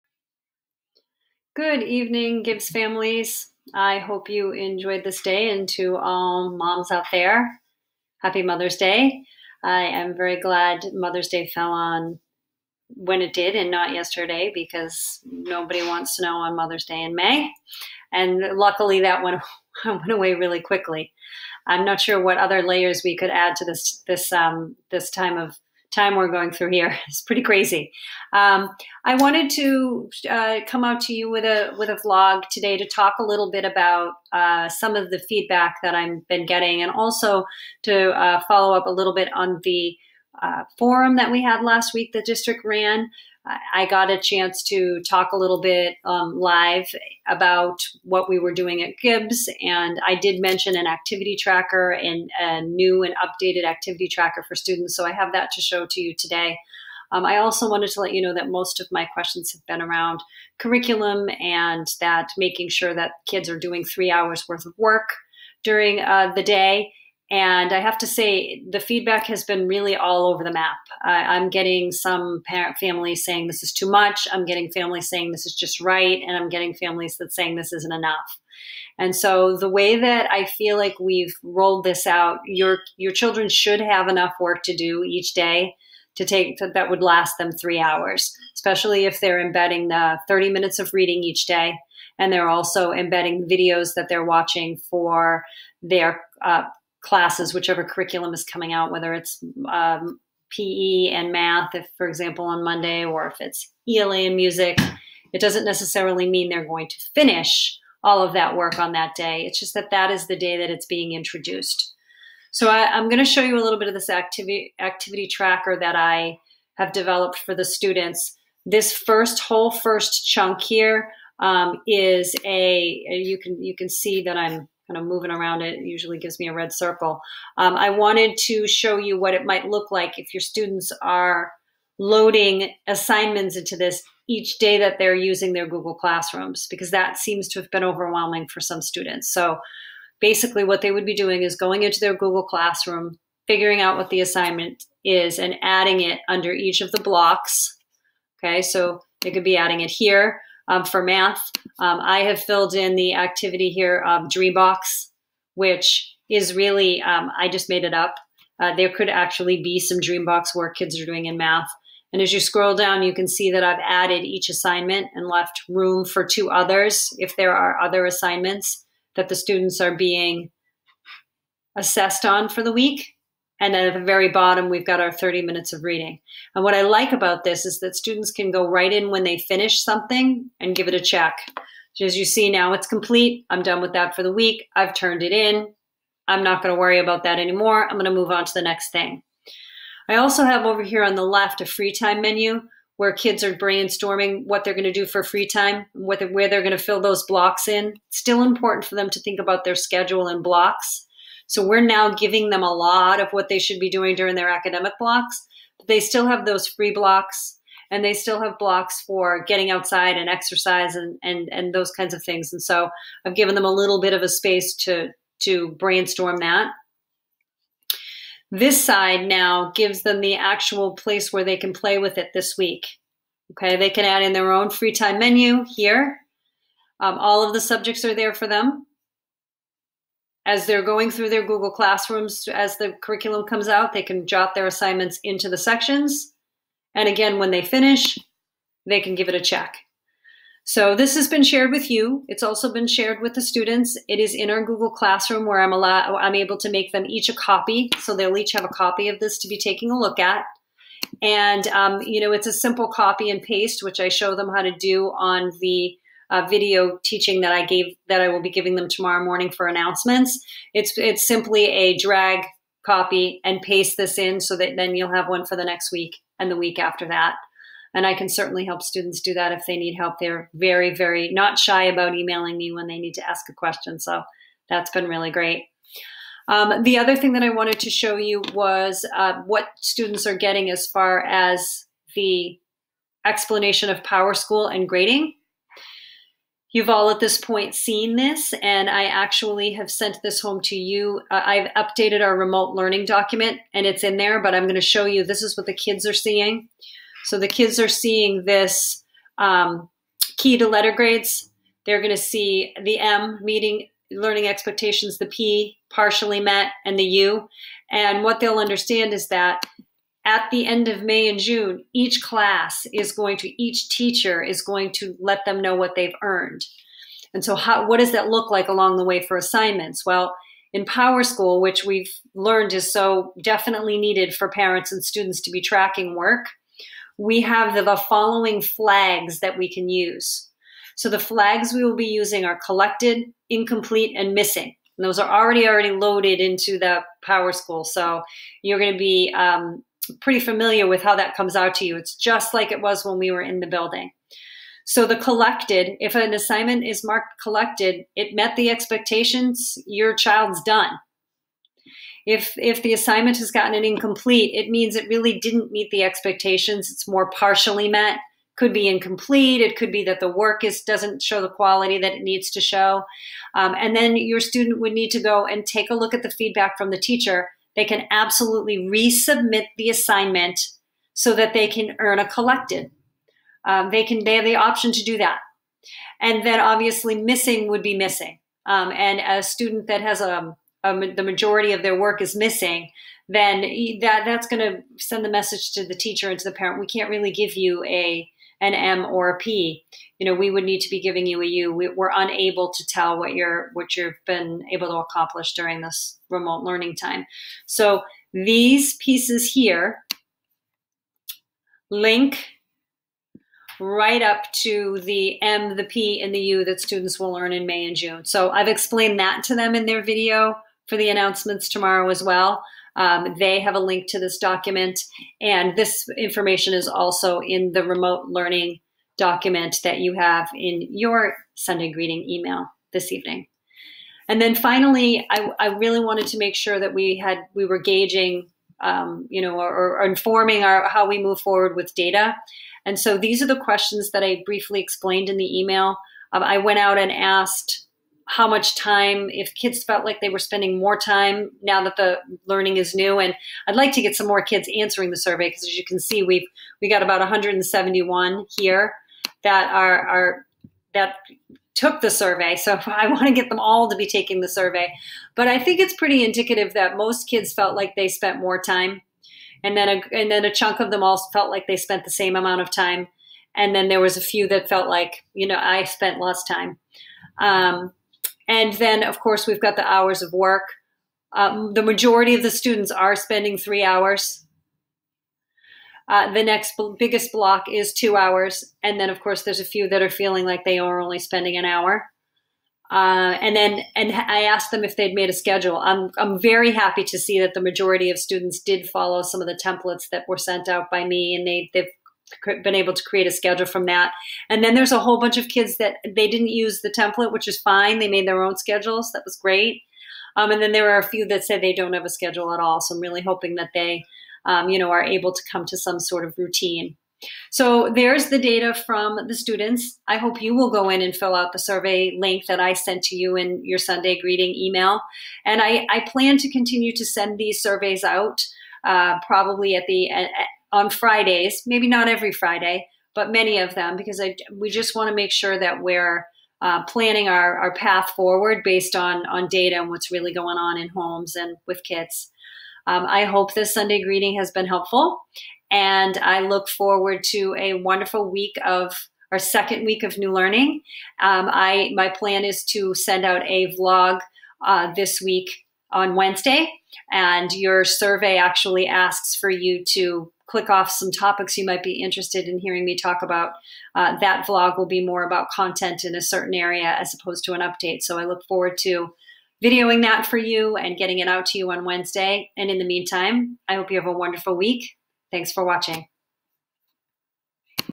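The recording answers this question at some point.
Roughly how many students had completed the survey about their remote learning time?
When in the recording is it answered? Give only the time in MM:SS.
07:27.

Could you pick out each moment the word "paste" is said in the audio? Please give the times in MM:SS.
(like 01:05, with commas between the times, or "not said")
04:13, 04:23.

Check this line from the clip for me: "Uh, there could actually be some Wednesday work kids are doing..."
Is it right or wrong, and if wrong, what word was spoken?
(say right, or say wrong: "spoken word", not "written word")
wrong: "Dreambox", not "Wednesday".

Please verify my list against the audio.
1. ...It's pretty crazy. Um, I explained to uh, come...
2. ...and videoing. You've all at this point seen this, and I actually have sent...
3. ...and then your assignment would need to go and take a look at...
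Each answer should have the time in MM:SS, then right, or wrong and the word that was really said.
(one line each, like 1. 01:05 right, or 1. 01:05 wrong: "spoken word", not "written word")
1. 00:27 wrong: "wanted", not "explained"
2. 04:44 wrong: "grading", not "videoing"
3. 06:03 wrong: "student", not "assignment".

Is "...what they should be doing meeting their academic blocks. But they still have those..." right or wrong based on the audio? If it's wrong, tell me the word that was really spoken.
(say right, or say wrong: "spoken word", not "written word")
wrong: "during", not "meeting".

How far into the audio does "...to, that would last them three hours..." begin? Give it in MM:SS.
01:26.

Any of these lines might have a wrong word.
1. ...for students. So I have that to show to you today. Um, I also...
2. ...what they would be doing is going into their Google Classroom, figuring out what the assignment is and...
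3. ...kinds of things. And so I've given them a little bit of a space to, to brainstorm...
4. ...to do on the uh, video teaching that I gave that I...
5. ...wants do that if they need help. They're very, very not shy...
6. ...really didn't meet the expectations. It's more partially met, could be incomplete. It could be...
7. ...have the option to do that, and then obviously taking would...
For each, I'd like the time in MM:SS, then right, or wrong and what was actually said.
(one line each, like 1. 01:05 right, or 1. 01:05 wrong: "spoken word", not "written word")
1. 00:54 right
2. 02:20 right
3. 03:31 right
4. 04:14 right
5. 04:28 wrong: "students", not "wants"
6. 05:55 right
7. 06:14 wrong: "missing", not "taking".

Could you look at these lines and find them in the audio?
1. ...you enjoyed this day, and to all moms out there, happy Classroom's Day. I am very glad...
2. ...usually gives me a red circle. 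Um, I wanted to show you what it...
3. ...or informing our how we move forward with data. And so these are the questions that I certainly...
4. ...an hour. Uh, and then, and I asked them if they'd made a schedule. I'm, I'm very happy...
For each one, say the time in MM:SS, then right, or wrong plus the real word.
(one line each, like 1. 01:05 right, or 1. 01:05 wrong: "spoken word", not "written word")
1. 00:04 wrong: "Mother", not "Classroom"
2. 02:05 right
3. 07:09 wrong: "briefly", not "certainly"
4. 08:01 right.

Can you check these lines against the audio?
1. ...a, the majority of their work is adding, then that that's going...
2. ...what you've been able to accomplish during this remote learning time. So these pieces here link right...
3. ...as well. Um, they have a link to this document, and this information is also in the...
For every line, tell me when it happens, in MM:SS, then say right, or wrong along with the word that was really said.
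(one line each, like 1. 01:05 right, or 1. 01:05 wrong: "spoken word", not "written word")
1. 06:20 wrong: "missing", not "adding"
2. 06:33 right
3. 06:52 right.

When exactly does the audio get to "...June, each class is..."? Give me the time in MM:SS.
05:11.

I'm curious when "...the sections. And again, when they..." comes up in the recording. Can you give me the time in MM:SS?
03:55.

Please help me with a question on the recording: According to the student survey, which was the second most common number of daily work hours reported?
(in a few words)
2 hours.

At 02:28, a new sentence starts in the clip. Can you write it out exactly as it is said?
Okay, so they could be adding it here um, for math.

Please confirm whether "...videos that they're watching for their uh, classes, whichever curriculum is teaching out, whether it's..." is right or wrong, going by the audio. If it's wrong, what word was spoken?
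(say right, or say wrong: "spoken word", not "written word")
wrong: "coming", not "teaching".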